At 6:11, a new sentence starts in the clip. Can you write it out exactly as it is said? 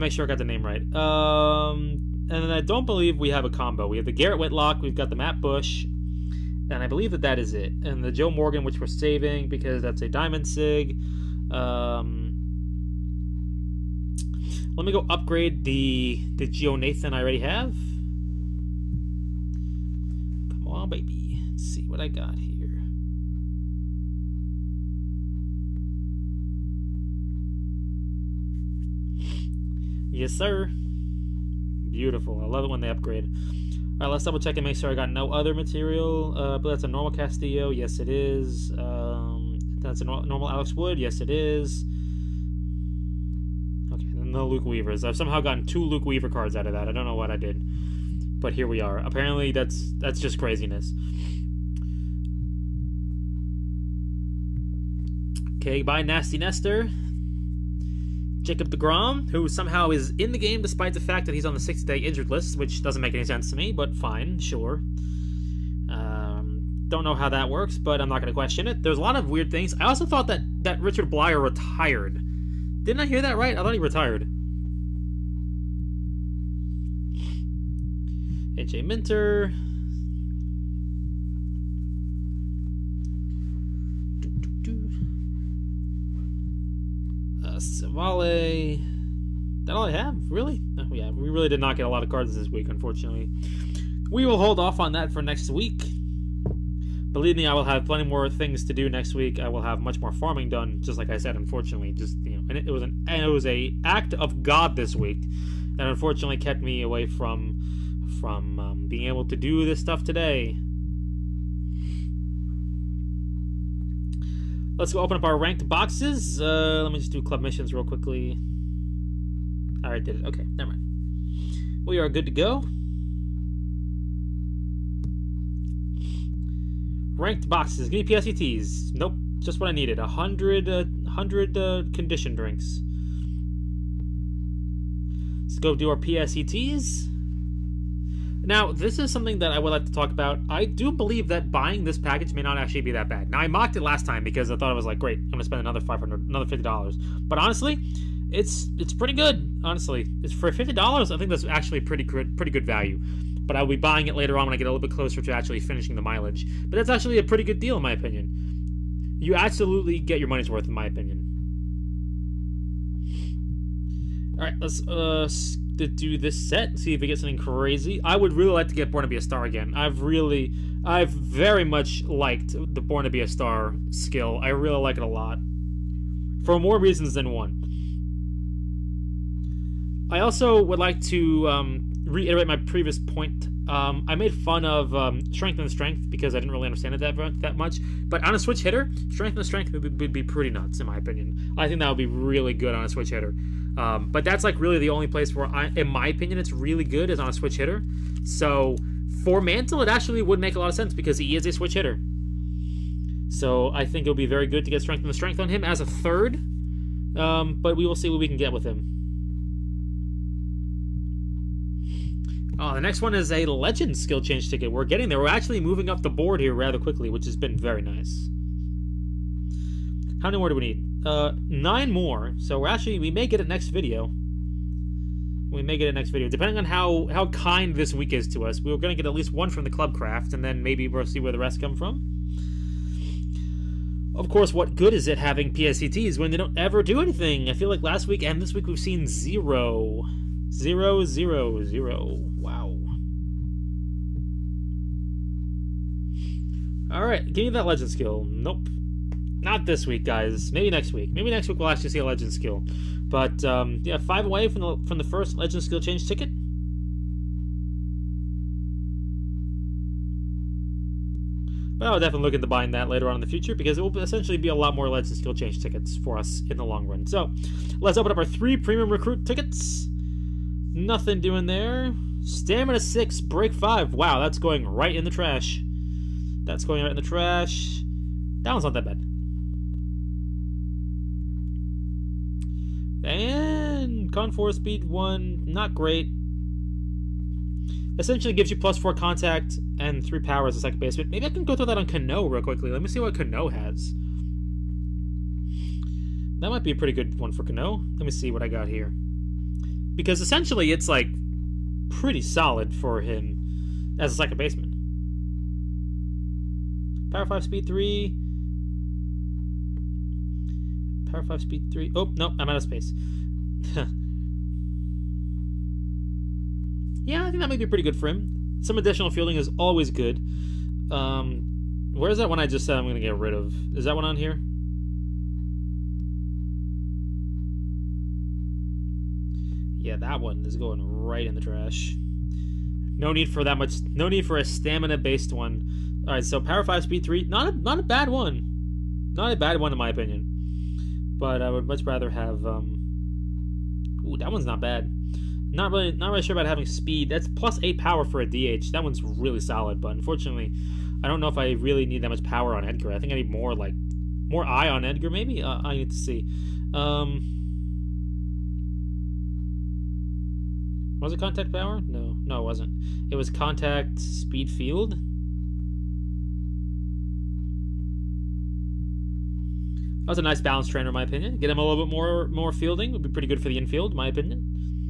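Get him a little bit more more fielding would be pretty good for the infield, in my opinion.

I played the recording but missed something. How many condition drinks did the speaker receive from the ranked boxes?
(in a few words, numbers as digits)
100.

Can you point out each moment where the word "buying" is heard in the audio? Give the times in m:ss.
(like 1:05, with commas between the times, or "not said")
2:21, 2:33, 4:22.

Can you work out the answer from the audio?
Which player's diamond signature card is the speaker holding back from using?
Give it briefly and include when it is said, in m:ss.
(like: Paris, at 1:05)
Joe Morgan, at 0:08.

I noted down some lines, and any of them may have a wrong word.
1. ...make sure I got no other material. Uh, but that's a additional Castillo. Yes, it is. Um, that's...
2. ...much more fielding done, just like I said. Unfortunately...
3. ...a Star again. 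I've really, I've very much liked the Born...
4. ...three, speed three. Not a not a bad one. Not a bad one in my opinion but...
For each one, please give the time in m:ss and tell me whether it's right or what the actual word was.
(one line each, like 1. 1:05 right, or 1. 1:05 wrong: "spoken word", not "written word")
1. 0:34 wrong: "normal", not "additional"
2. 1:39 wrong: "farming", not "fielding"
3. 2:49 right
4. 5:36 wrong: "five", not "three".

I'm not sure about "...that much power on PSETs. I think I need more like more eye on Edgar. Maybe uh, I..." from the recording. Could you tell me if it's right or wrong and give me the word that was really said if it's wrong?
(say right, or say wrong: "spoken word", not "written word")
wrong: "Edgar", not "PSETs".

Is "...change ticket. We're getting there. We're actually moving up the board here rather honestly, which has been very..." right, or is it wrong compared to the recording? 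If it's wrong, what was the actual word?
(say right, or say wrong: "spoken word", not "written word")
wrong: "quickly", not "honestly".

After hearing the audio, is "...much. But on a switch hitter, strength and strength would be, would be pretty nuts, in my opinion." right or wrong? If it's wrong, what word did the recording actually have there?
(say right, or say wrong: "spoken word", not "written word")
right.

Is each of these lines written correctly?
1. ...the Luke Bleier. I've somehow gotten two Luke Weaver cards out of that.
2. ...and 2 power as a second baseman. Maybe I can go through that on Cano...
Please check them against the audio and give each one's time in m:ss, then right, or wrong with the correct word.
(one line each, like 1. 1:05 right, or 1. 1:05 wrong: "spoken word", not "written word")
1. 0:44 wrong: "Weavers", not "Bleier"
2. 4:49 wrong: "3", not "2".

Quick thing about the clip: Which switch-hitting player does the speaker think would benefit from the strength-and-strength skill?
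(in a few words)
Mantle.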